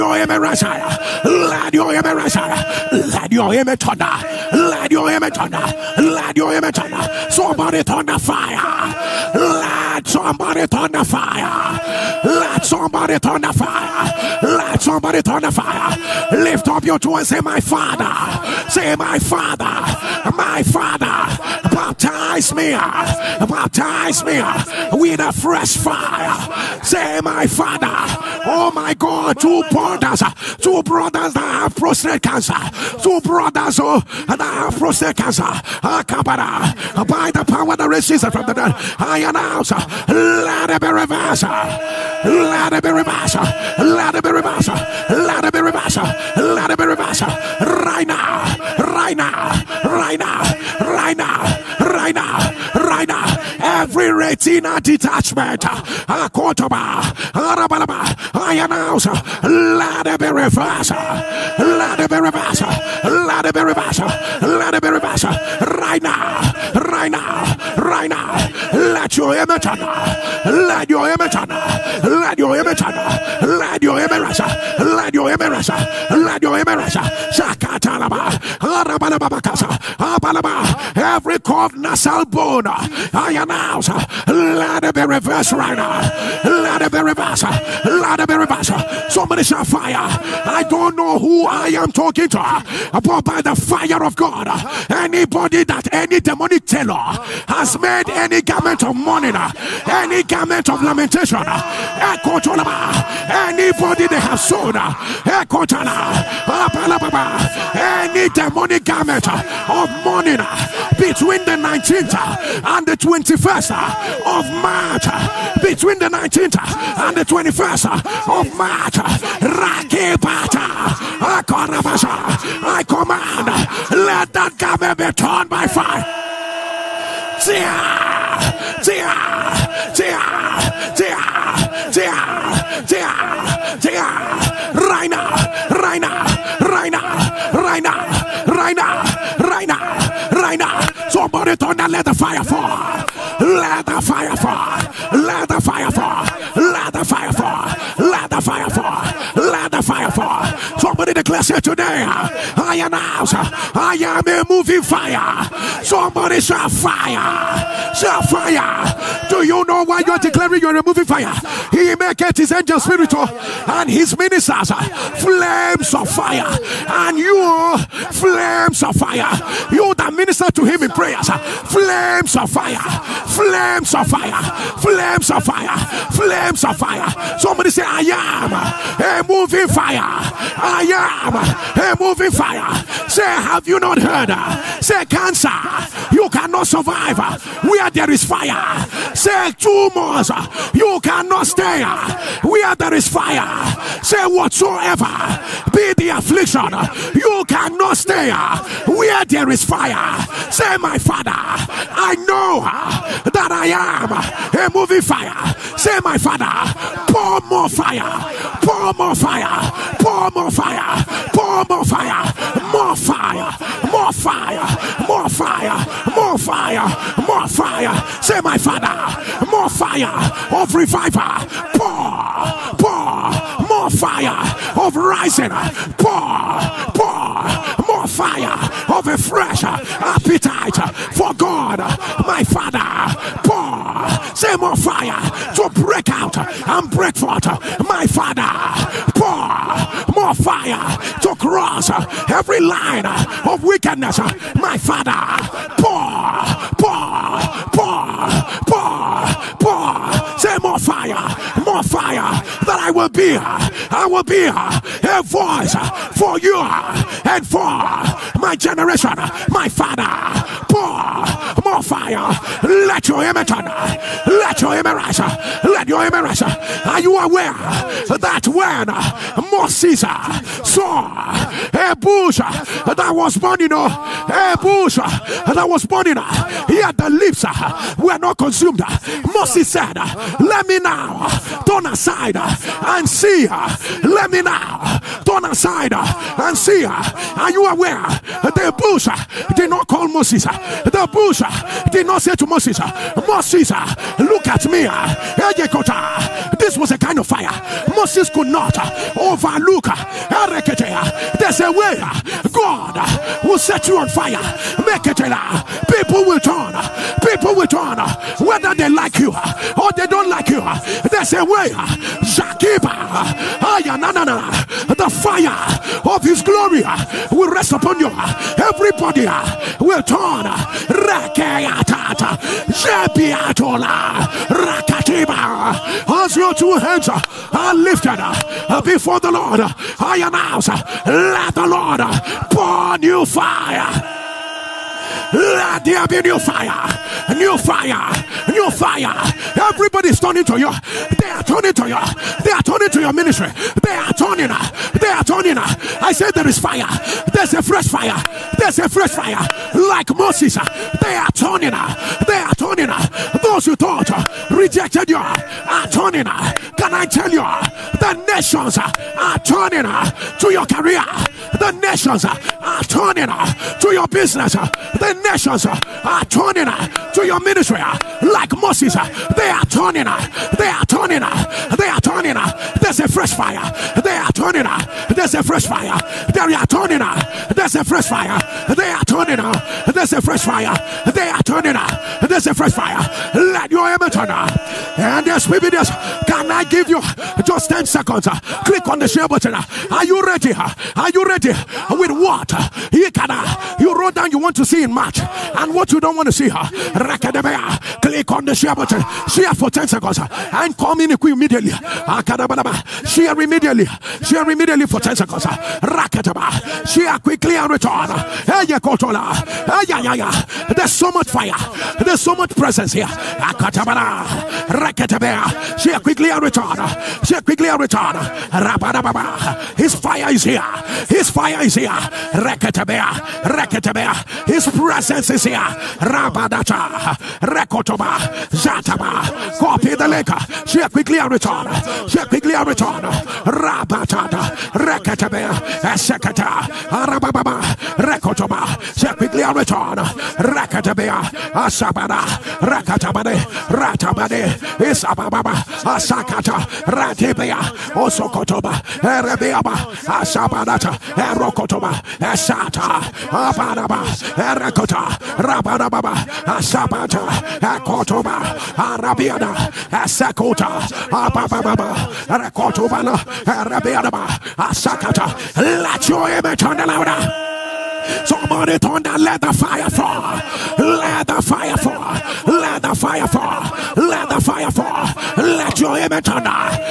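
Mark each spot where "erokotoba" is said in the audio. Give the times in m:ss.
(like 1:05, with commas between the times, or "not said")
7:31.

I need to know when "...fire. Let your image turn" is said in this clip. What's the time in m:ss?
4:21.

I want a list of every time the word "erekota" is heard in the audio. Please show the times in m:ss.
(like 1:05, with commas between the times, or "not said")
7:34.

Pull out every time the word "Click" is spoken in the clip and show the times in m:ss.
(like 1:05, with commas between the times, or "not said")
6:28, 6:36.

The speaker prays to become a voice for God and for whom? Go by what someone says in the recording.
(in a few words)
my generation.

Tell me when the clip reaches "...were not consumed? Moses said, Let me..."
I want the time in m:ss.
4:37.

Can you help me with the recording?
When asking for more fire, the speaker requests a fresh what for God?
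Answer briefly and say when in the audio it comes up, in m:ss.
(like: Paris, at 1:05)
appetite, at 3:50.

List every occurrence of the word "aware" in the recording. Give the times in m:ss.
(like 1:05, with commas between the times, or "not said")
4:27, 4:47.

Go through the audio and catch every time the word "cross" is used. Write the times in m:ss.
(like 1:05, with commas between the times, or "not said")
4:01.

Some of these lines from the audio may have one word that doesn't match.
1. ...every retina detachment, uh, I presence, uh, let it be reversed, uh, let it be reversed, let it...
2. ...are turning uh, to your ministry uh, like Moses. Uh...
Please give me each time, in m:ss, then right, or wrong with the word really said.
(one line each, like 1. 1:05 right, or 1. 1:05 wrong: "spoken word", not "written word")
1. 0:53 wrong: "announce", not "presence"
2. 6:05 right.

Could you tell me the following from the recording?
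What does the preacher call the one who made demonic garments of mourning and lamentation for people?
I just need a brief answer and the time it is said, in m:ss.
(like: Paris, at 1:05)
demonic tailor, at 1:36.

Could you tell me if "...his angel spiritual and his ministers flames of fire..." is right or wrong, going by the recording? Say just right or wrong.
right.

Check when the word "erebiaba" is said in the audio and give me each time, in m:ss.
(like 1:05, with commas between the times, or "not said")
7:29, 7:43.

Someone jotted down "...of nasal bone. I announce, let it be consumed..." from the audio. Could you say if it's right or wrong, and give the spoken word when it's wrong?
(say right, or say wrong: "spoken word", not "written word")
wrong: "reversed", not "consumed".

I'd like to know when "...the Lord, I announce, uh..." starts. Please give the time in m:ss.
5:29.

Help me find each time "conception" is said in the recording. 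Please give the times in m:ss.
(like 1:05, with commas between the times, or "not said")
not said.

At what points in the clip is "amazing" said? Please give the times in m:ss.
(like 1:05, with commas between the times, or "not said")
not said.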